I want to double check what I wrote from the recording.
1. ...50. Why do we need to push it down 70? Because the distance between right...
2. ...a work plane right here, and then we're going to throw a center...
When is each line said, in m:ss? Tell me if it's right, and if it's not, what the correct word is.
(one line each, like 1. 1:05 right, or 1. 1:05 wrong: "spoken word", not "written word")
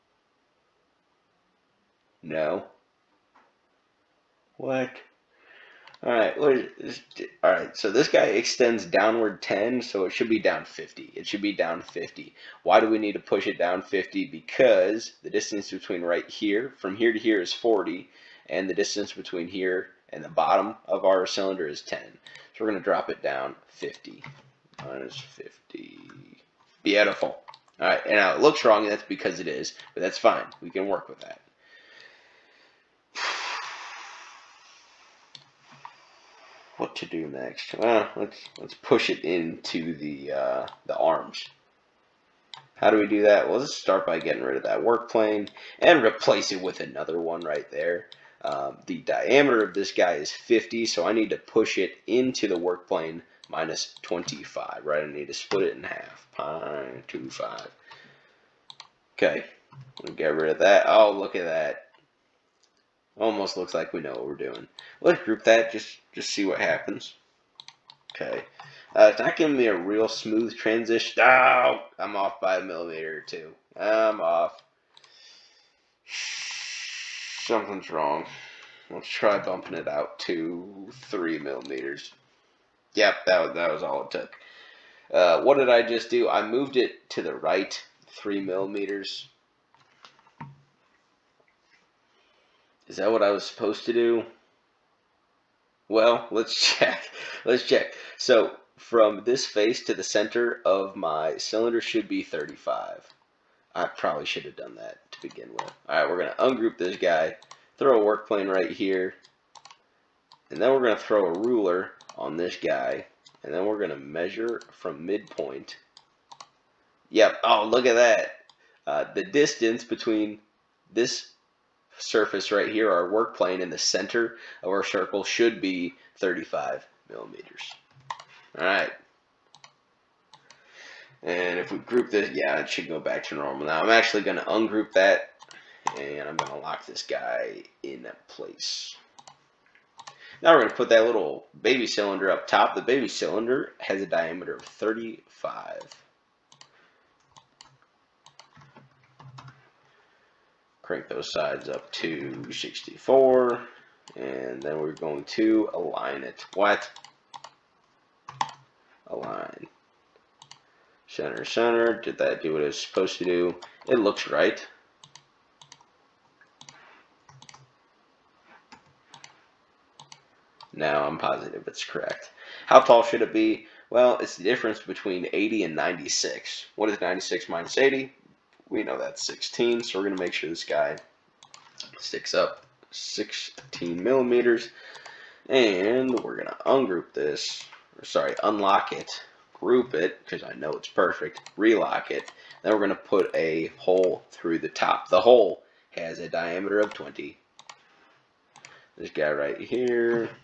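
1. 0:11 wrong: "50", not "70"
2. 1:47 wrong: "ruler", not "center".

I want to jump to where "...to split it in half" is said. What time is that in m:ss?
0:55.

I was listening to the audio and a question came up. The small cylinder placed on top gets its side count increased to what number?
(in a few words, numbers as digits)
64.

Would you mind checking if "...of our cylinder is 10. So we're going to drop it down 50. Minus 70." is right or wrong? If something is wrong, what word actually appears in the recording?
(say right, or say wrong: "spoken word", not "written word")
wrong: "50", not "70".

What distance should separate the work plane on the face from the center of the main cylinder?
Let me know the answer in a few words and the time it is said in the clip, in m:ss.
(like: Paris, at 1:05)
35 millimeters, at 2:06.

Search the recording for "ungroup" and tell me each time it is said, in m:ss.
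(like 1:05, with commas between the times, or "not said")
1:46, 2:14, 3:06.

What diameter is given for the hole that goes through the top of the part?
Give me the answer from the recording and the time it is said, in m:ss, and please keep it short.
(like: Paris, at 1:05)
20, at 3:16.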